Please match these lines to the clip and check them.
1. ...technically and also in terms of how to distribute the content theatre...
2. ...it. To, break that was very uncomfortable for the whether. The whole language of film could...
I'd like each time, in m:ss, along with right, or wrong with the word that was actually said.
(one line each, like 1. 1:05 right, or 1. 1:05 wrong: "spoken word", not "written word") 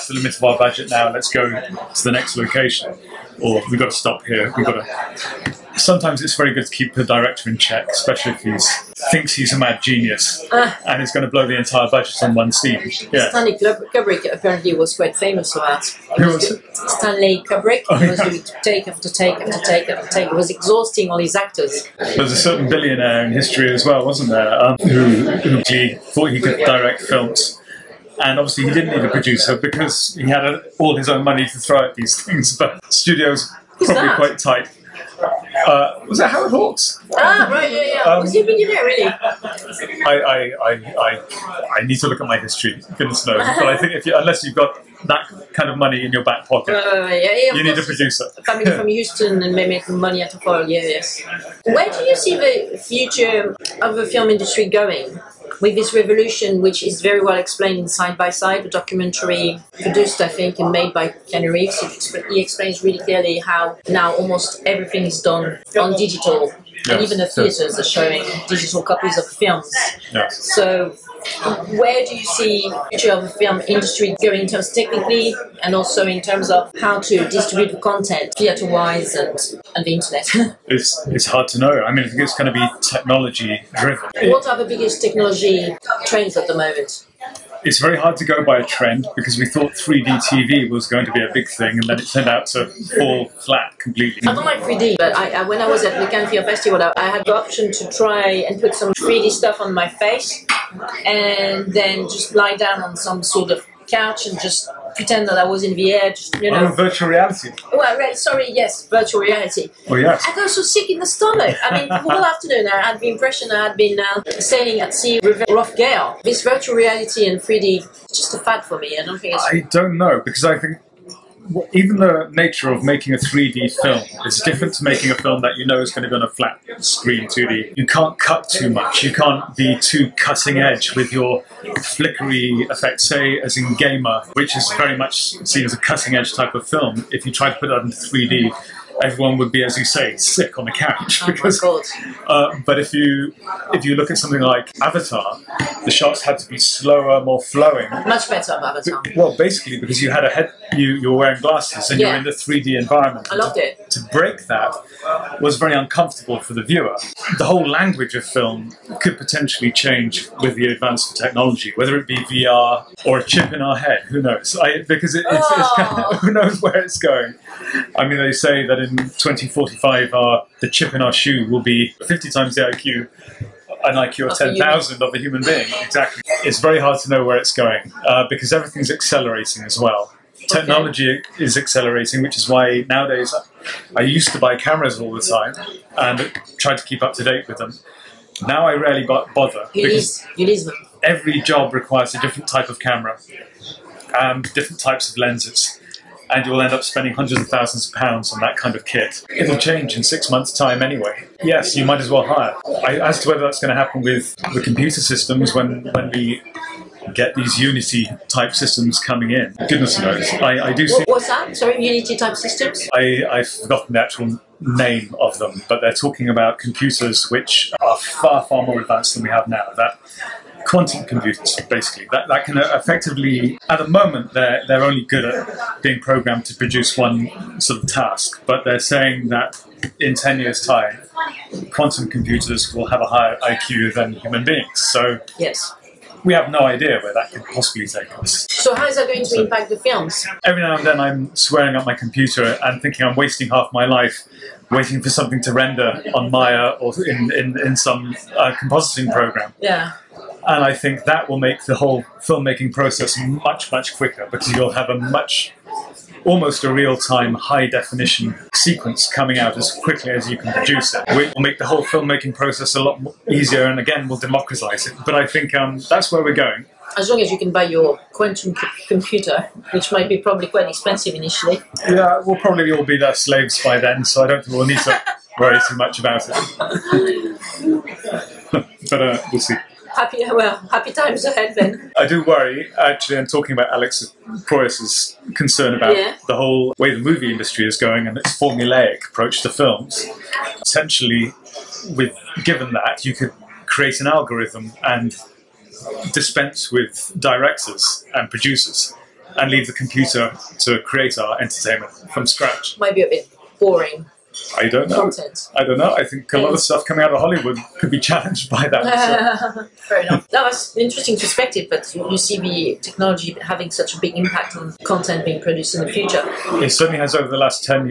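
1. 1:14 right
2. 2:33 wrong: "viewer", not "whether".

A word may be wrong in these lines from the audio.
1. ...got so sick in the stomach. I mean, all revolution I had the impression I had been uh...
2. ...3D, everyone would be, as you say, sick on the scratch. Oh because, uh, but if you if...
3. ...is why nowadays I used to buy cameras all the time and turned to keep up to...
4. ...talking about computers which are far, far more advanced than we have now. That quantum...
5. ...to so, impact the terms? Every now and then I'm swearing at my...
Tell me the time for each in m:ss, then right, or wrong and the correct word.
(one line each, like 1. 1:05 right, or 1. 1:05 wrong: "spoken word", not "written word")
1. 1:50 wrong: "afternoon", not "revolution"
2. 2:17 wrong: "couch", not "scratch"
3. 3:02 wrong: "tried", not "turned"
4. 3:35 right
5. 3:59 wrong: "films", not "terms".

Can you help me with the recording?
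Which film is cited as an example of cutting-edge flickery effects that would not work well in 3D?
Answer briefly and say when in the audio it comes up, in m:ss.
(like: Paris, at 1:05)
Gamer, at 2:13.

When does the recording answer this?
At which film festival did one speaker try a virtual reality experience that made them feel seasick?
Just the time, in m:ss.
1:36.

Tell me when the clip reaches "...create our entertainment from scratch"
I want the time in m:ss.
5:00.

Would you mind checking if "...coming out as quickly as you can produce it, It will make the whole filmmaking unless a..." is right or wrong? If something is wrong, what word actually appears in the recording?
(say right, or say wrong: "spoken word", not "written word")
wrong: "process", not "unless".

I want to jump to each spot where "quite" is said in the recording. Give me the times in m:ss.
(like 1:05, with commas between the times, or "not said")
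0:14, 0:34, 4:30.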